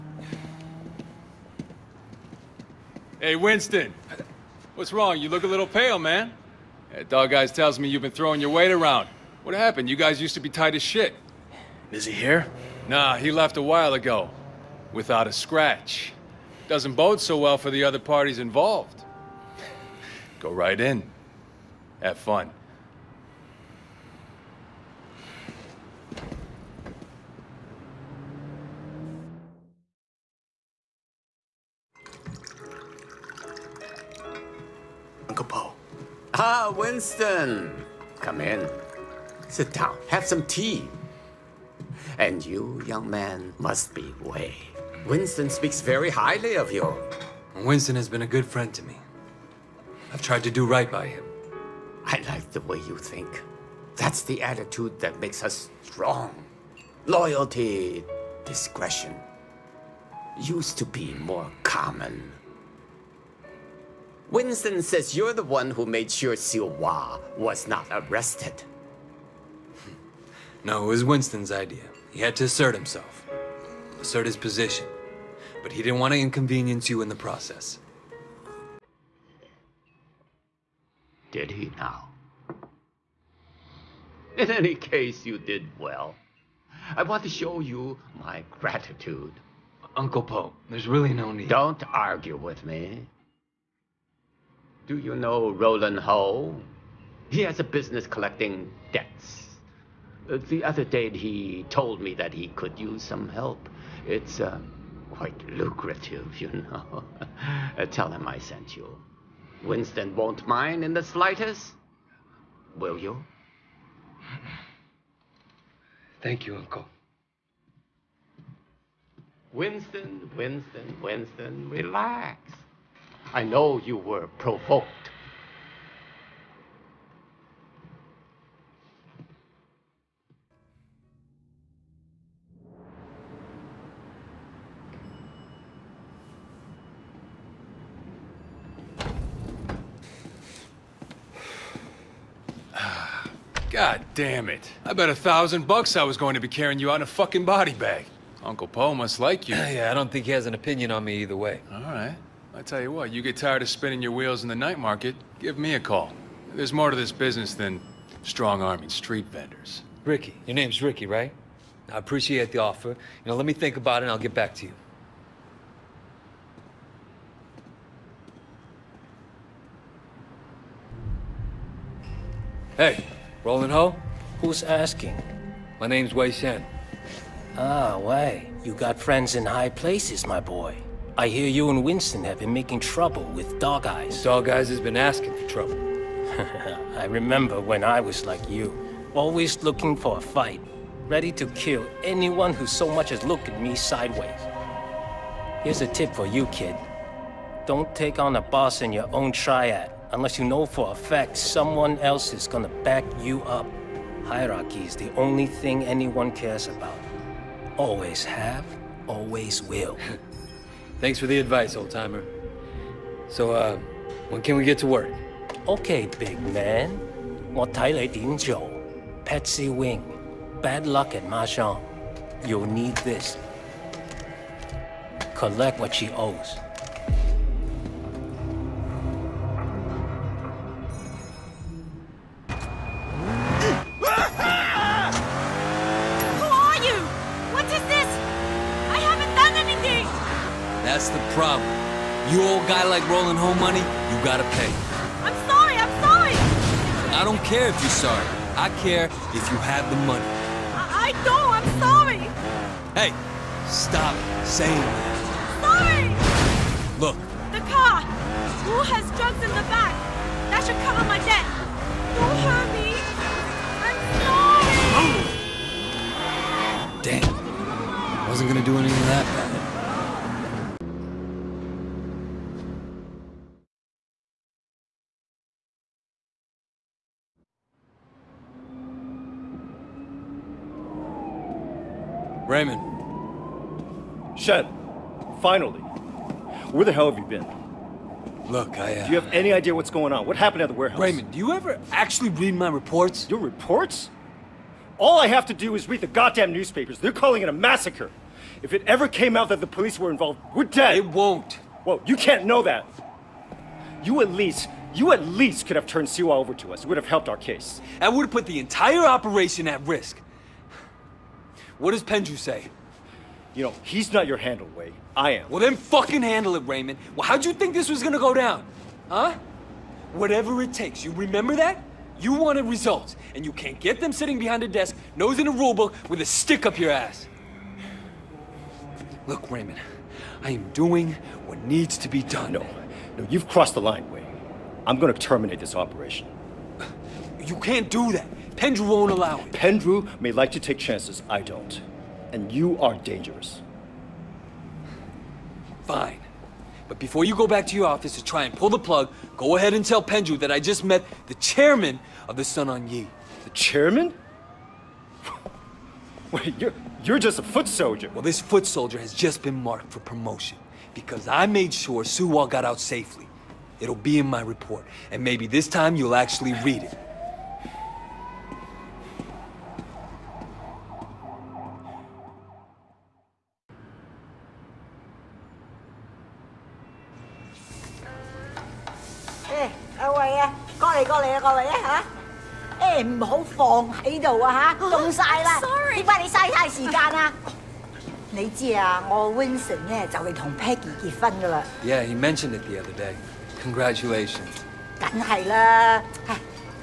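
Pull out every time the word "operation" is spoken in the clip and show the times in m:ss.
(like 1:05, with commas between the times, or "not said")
5:09, 5:35.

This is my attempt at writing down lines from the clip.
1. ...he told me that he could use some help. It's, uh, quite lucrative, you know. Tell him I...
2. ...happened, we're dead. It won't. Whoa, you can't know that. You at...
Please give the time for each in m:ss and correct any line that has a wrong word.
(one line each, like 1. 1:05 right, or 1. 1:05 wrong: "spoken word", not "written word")
1. 1:41 right
2. 5:00 wrong: "involved", not "happened".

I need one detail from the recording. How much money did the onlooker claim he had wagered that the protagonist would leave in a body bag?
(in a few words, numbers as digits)
1000 bucks.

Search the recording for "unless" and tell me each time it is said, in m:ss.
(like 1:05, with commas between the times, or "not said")
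3:20.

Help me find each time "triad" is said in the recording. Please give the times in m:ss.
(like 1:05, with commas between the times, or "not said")
3:19.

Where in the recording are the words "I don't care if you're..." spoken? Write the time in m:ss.
4:07.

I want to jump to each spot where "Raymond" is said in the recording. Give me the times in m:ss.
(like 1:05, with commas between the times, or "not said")
4:42, 4:50, 5:16, 5:29.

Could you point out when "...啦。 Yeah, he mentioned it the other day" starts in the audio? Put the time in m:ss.
6:31.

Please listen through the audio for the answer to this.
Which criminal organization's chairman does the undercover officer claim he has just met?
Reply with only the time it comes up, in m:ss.
5:52.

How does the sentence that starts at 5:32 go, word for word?
No, no, you've crossed the line, Wei.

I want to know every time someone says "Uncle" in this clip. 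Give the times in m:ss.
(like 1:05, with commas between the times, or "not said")
0:35, 1:29, 1:56, 2:28.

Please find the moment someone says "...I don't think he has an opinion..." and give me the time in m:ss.
2:29.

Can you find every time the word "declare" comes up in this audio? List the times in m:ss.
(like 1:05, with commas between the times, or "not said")
not said.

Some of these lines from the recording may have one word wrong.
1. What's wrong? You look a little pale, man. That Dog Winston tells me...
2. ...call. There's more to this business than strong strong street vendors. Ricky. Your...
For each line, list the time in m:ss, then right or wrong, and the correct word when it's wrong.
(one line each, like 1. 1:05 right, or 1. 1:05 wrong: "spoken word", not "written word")
1. 0:04 wrong: "Eyes", not "Winston"
2. 2:35 wrong: "arming", not "strong".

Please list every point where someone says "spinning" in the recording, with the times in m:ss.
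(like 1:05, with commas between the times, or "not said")
2:33.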